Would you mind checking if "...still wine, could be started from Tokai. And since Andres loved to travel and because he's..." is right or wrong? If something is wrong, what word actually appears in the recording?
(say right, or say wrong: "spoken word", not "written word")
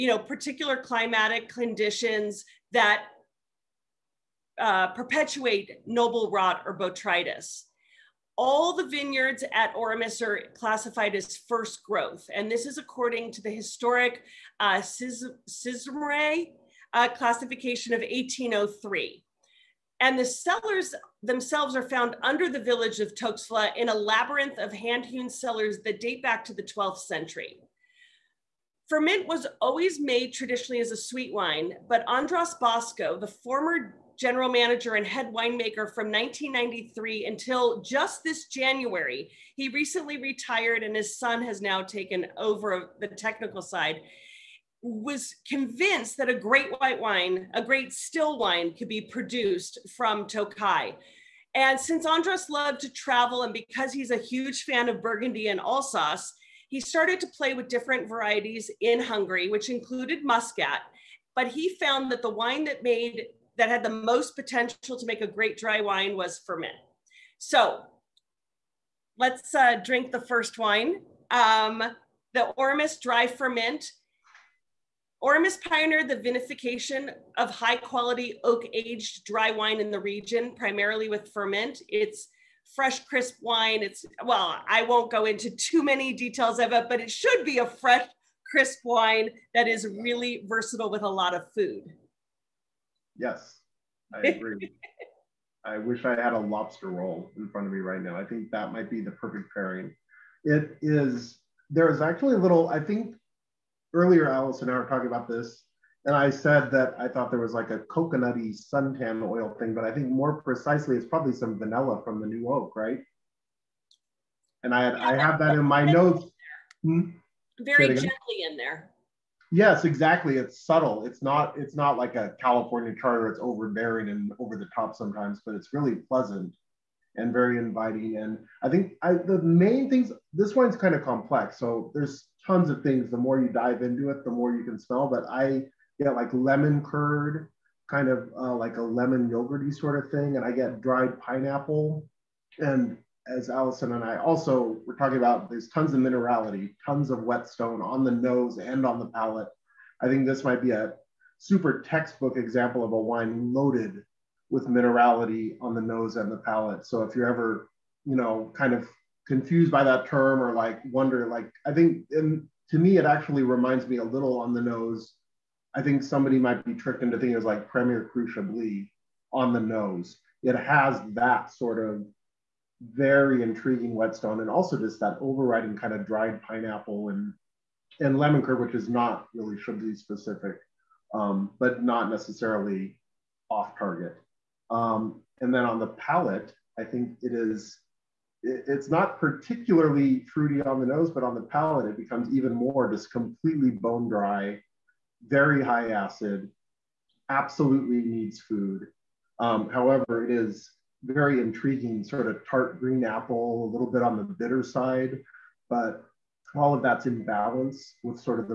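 wrong: "produced", not "started".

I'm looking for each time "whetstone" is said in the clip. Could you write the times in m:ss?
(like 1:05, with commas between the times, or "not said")
2:27, 2:53.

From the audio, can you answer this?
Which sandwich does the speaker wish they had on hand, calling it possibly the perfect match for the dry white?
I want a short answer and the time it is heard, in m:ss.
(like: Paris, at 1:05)
Lobster roll, at 1:36.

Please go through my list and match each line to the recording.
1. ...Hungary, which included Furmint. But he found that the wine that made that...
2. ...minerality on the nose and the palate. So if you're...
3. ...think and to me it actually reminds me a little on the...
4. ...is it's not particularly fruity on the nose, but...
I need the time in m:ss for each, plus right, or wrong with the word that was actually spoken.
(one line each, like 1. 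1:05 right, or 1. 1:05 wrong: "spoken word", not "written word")
1. 0:59 wrong: "Muscat", not "Furmint"
2. 2:34 right
3. 2:41 right
4. 3:07 right.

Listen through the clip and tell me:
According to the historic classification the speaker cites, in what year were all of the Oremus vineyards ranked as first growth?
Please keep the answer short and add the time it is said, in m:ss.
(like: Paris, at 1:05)
1803, at 0:18.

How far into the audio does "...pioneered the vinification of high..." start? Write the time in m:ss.
1:15.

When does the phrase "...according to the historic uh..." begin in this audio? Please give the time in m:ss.
0:12.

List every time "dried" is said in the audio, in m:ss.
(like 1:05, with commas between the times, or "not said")
2:20, 2:56.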